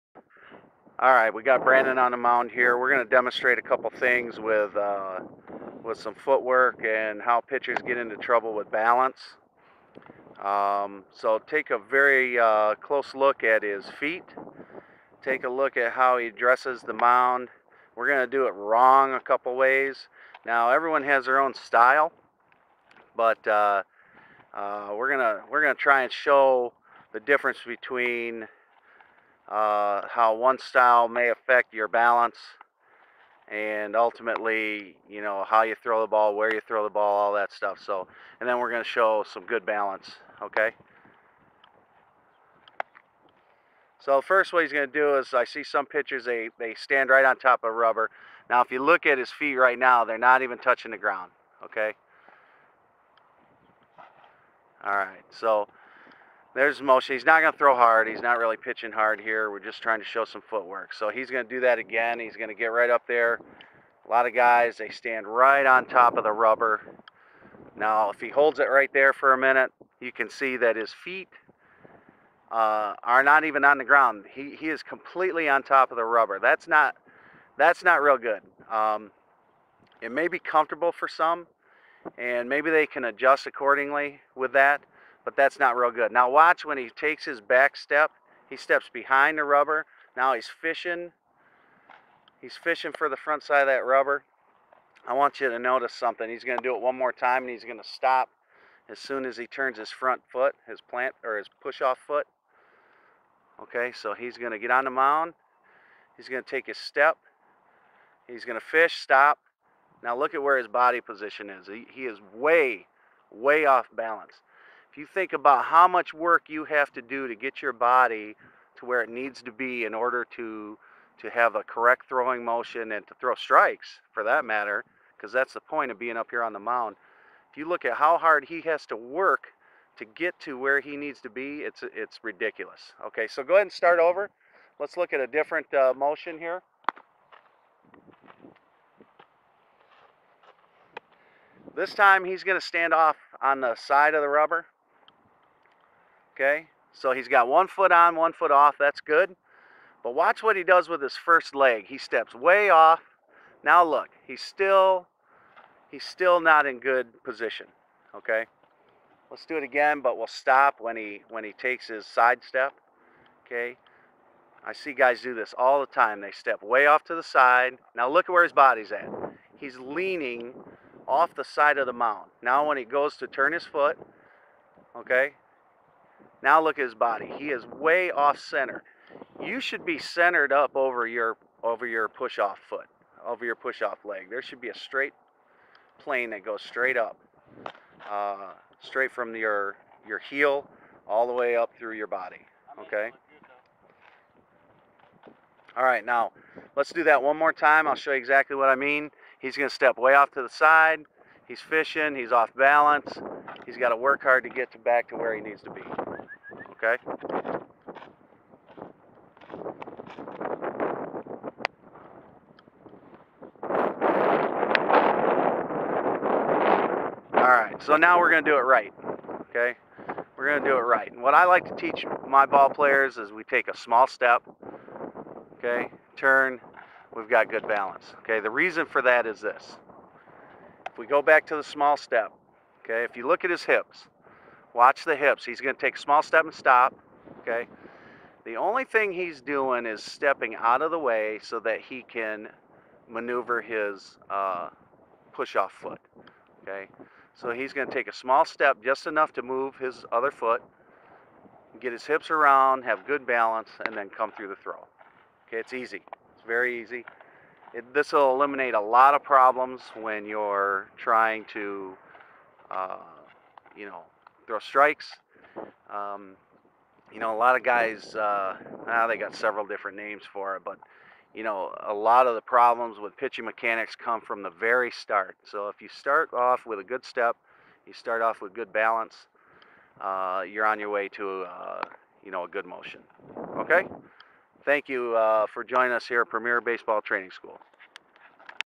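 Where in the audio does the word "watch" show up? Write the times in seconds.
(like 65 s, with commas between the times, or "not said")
86 s, 150 s, 234 s.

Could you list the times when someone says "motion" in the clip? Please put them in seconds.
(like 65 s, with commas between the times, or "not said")
122 s, 135 s, 282 s.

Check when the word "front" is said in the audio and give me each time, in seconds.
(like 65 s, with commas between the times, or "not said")
93 s, 99 s.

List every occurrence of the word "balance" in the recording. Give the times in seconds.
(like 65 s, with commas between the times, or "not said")
8 s, 31 s, 39 s, 113 s, 202 s, 227 s, 253 s, 278 s.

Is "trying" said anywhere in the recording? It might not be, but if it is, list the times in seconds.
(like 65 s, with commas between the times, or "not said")
59 s, 260 s.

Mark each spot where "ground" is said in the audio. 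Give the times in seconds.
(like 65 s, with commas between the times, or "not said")
50 s, 73 s.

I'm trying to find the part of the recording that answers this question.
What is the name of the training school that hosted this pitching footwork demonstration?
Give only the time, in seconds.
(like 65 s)
286 s.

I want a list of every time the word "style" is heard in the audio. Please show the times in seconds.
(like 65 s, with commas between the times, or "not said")
21 s, 30 s.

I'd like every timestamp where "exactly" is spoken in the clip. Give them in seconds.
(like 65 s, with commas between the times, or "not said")
198 s.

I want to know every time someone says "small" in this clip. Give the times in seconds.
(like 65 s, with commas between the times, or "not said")
223 s, 231 s, 235 s, 248 s.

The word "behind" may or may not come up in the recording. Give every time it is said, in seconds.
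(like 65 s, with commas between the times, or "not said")
88 s.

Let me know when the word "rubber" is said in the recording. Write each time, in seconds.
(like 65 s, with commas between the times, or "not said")
47 s, 66 s, 76 s, 89 s, 93 s, 144 s.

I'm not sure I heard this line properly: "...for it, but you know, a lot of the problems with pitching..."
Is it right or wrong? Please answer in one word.
right.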